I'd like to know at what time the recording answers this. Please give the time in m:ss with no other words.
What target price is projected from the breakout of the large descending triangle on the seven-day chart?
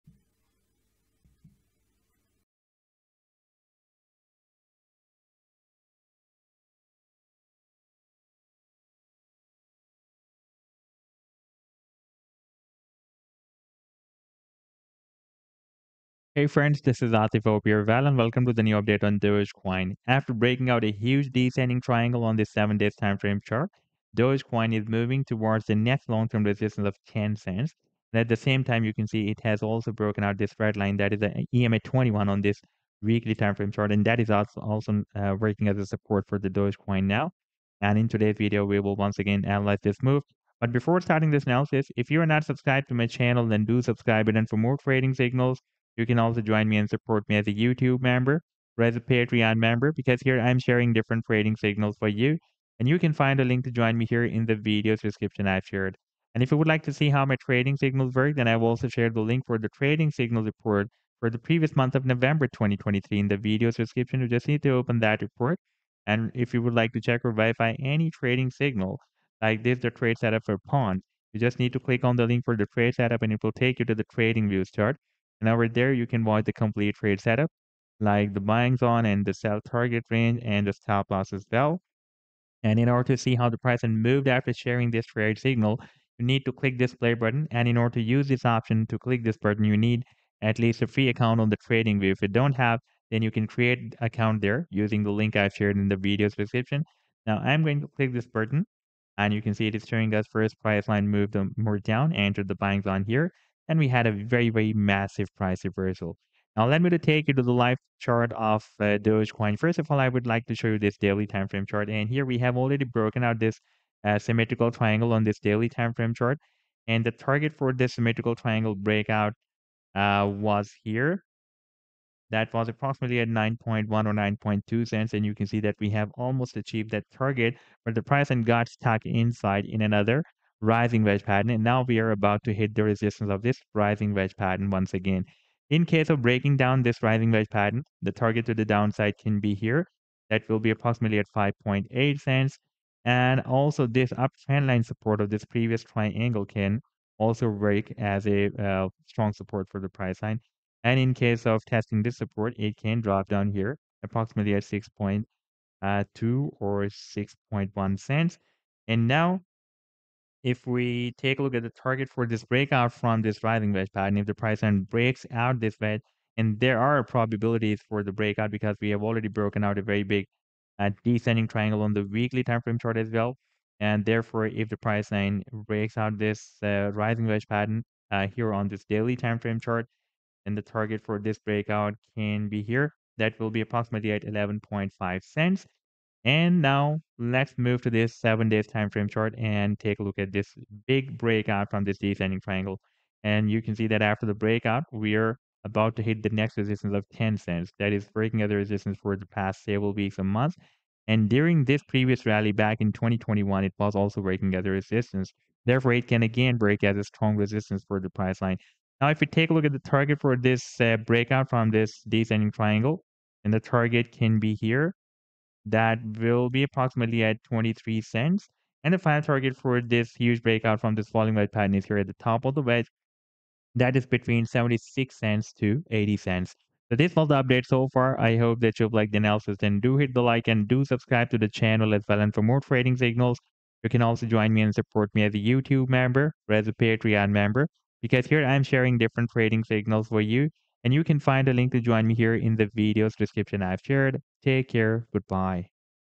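3:37.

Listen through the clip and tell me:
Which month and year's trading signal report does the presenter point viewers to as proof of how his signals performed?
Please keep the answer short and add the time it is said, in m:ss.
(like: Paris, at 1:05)
November 2023, at 1:02.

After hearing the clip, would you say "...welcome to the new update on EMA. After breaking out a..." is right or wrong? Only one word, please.
wrong.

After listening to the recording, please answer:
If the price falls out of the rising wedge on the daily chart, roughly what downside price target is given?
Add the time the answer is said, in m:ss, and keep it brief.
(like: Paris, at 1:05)
5.8 cents, at 2:21.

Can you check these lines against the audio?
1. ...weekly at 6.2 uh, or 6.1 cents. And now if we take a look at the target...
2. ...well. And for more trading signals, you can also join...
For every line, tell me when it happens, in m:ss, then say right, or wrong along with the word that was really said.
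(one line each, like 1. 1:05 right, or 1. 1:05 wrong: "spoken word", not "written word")
1. 2:34 wrong: "approximately", not "weekly"
2. 3:52 right.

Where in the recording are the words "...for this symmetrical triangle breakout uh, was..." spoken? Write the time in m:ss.
1:57.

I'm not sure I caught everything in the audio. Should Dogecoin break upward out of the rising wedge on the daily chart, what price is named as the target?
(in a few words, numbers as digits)
11.5 cents.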